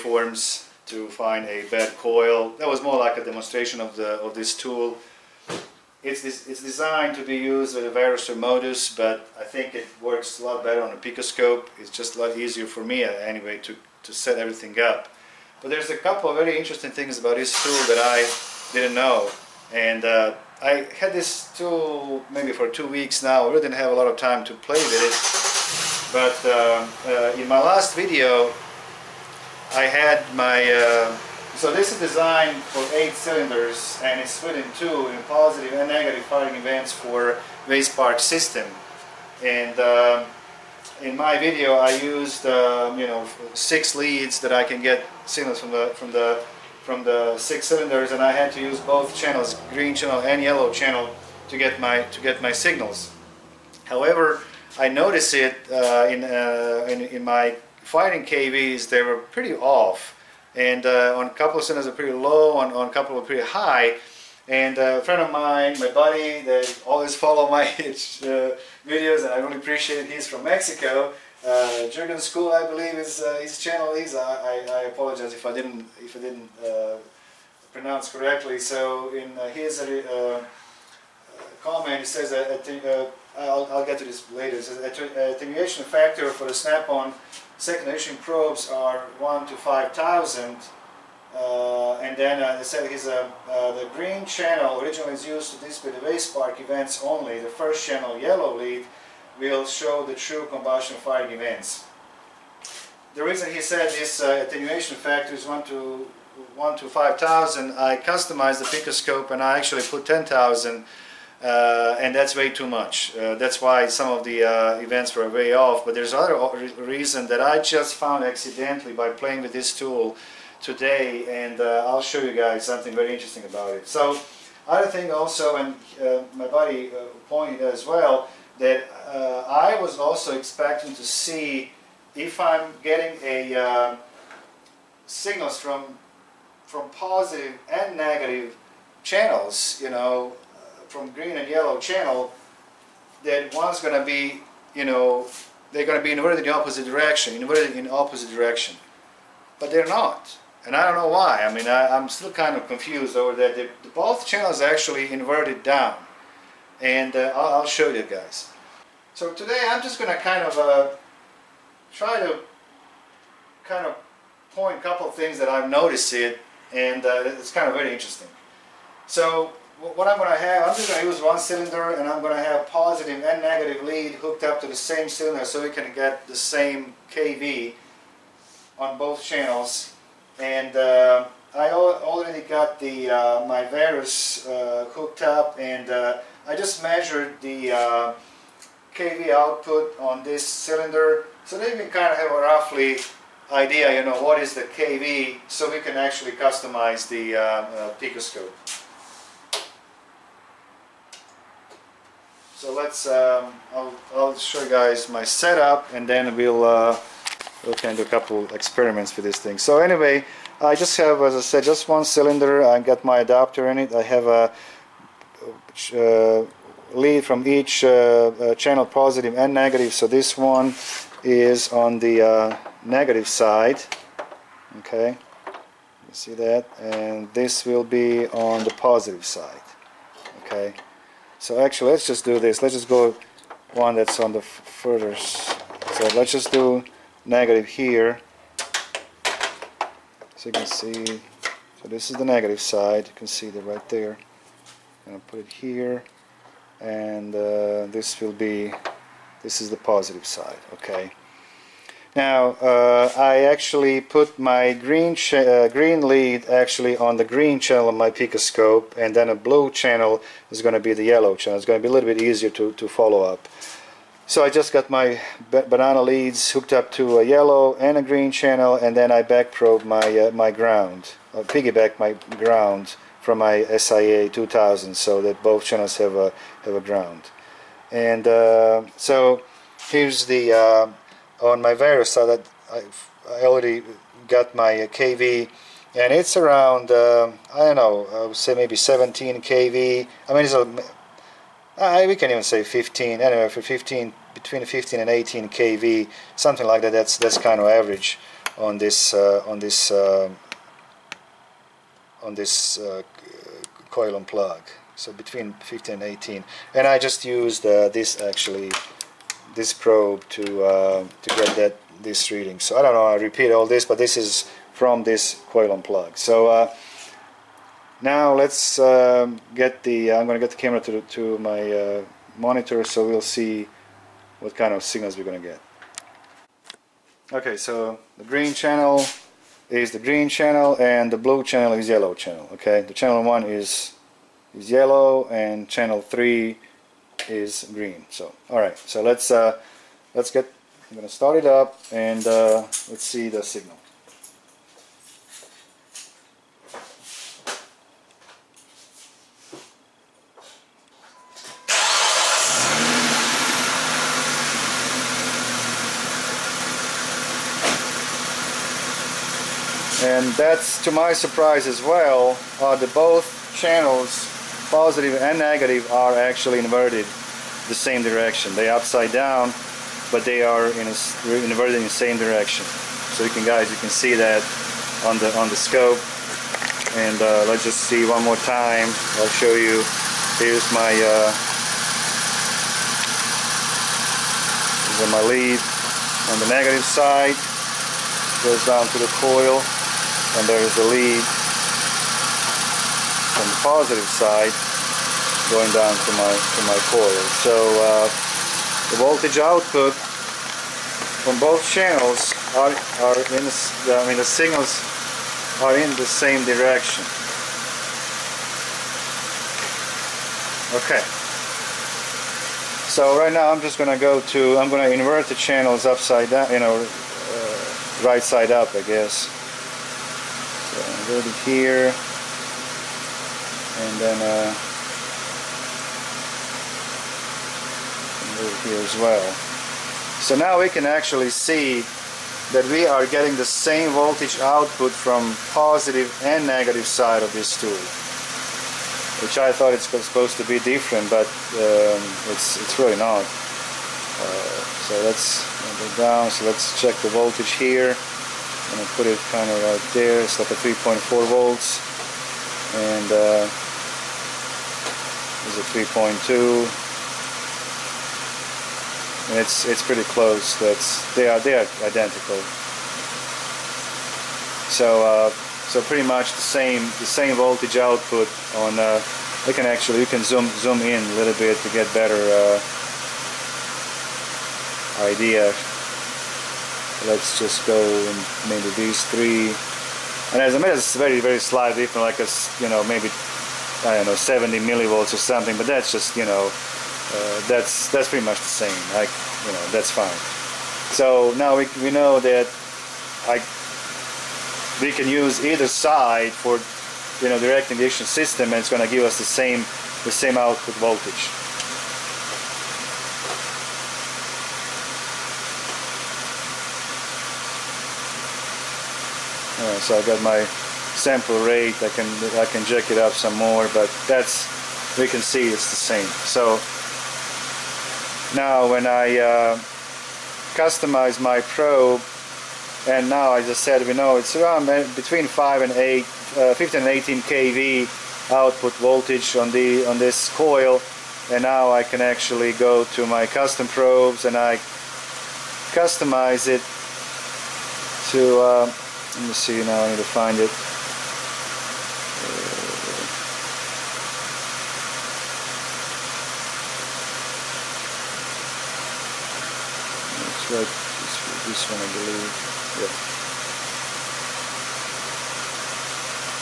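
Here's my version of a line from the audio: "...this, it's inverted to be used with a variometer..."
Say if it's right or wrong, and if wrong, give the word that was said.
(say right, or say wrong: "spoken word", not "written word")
wrong: "designed", not "inverted".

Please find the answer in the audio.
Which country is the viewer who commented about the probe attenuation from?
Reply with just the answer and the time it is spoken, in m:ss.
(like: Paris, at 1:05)
Mexico, at 1:10.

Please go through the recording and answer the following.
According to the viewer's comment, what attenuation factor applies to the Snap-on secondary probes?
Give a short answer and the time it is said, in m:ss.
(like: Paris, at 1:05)
1 to 5,000, at 1:29.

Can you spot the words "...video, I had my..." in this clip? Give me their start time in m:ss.
0:28.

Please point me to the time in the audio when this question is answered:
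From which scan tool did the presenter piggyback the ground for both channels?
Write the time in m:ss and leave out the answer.
4:33.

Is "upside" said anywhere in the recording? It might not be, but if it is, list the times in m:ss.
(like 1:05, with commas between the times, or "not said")
6:08, 6:55.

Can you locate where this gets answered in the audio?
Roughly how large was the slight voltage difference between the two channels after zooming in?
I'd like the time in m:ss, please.
8:04.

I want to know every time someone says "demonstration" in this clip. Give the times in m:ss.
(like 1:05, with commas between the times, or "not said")
0:03.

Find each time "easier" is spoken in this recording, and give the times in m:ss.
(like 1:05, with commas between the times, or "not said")
0:12, 4:22.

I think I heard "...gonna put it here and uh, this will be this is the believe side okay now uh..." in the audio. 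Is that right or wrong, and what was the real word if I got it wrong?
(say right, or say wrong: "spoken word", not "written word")
wrong: "positive", not "believe".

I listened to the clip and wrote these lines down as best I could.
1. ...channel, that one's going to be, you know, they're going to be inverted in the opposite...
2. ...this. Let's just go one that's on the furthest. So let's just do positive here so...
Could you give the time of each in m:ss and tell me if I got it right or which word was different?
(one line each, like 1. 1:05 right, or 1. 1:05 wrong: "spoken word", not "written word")
1. 2:21 right
2. 3:52 wrong: "negative", not "positive".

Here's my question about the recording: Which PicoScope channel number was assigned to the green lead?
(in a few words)
Channel 3.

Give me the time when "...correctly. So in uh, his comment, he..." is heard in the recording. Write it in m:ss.
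1:18.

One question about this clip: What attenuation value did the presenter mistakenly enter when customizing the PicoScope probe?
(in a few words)
10,000.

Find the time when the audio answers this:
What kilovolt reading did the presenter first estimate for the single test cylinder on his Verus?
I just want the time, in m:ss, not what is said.
4:48.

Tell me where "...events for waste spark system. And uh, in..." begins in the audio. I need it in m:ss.
0:36.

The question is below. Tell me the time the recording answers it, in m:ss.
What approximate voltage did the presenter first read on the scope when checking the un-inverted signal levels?
7:30.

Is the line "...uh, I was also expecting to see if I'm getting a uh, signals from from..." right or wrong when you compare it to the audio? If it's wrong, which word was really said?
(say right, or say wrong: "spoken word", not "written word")
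right.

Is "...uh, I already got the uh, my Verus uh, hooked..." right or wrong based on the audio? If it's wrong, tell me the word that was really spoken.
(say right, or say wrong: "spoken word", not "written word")
right.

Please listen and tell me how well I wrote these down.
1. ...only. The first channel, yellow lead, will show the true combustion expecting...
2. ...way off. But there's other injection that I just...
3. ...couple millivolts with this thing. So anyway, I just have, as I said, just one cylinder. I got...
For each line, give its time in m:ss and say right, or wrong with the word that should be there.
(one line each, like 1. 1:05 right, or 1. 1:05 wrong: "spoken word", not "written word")
1. 1:37 wrong: "firing", not "expecting"
2. 1:55 wrong: "reason", not "injection"
3. 3:28 wrong: "experiments", not "millivolts".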